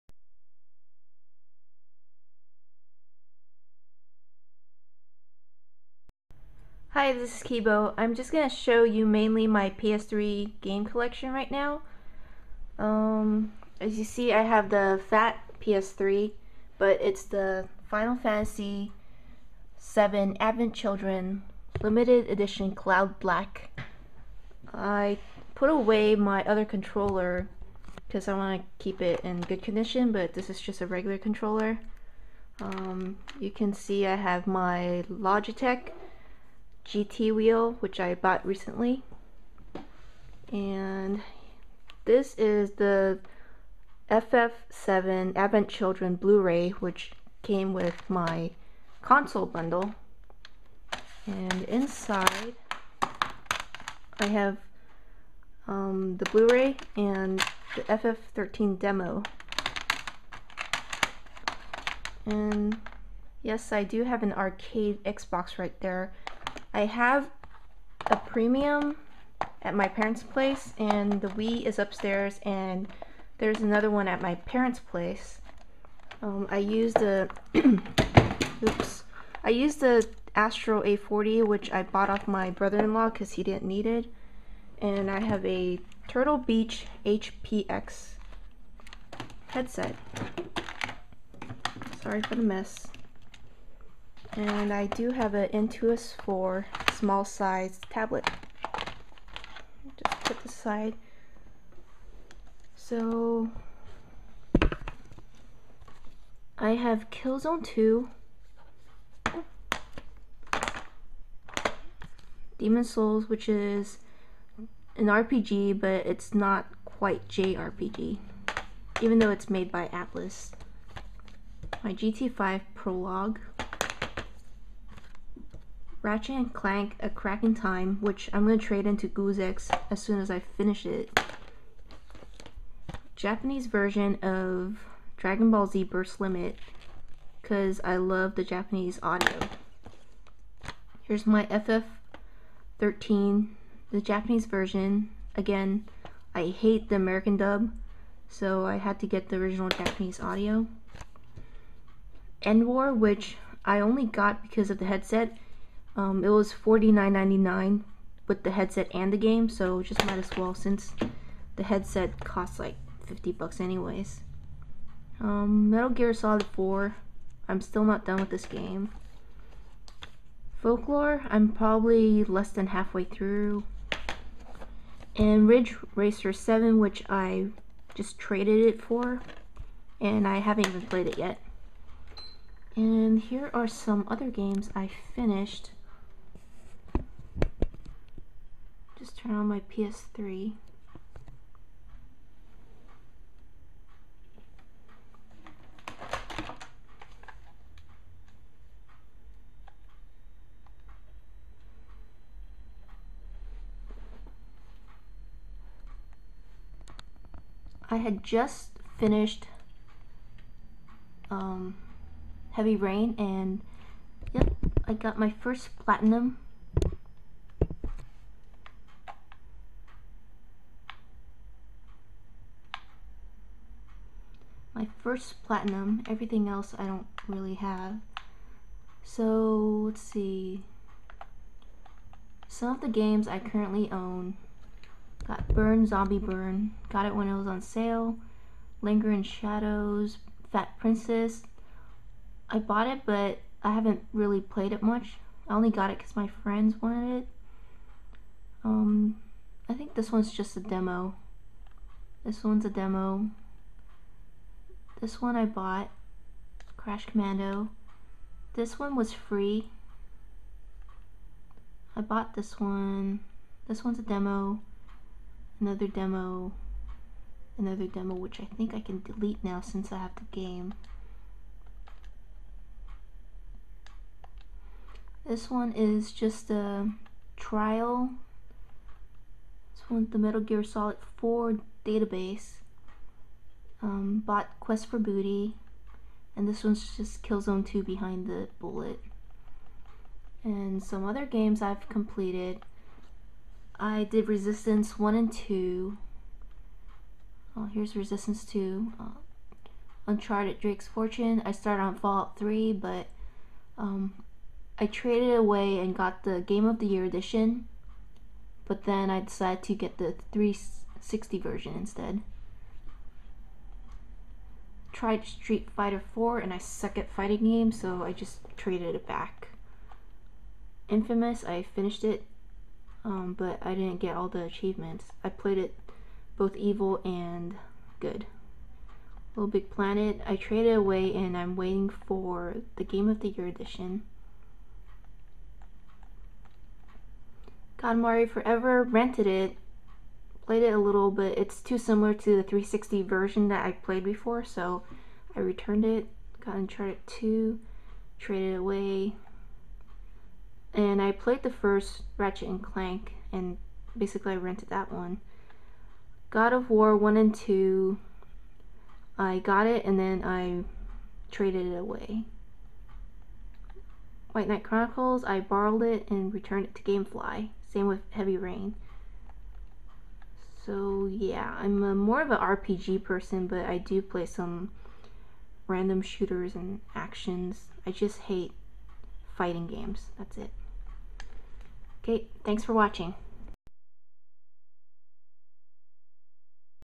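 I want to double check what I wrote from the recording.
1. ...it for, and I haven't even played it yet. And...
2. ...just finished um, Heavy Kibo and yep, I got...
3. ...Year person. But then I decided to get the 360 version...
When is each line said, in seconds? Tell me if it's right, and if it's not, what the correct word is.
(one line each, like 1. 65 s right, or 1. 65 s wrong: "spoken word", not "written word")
1. 178 s right
2. 208 s wrong: "Rain", not "Kibo"
3. 306 s wrong: "edition", not "person".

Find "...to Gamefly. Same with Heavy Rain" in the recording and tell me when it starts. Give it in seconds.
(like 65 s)
366 s.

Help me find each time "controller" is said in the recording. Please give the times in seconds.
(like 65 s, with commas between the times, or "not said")
26 s, 31 s.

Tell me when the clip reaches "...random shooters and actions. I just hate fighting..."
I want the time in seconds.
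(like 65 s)
375 s.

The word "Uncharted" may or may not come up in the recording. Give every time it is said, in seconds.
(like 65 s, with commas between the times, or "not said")
300 s, 346 s.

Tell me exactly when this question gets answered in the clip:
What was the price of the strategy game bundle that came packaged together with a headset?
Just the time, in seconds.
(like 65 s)
156 s.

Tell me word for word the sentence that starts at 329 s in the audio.
Little Big Planet, I traded away and I'm waiting for the Game of the Year edition.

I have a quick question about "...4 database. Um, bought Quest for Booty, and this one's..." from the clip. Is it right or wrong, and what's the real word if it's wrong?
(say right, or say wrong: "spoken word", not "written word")
right.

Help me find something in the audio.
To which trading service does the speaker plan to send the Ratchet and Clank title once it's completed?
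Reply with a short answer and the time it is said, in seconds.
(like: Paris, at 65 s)
Goozex, at 129 s.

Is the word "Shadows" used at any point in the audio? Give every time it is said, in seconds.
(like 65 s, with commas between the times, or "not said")
239 s.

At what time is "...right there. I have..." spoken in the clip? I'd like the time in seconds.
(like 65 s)
65 s.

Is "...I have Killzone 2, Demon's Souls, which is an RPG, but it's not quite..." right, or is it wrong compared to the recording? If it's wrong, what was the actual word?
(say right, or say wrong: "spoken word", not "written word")
right.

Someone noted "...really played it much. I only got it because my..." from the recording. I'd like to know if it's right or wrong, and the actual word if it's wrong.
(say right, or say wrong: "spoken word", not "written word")
right.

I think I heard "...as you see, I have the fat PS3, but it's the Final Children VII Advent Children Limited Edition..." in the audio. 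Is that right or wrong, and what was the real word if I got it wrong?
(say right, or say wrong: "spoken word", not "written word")
wrong: "Fantasy", not "Children".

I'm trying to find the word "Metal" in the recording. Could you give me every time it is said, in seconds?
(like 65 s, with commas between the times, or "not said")
165 s, 280 s.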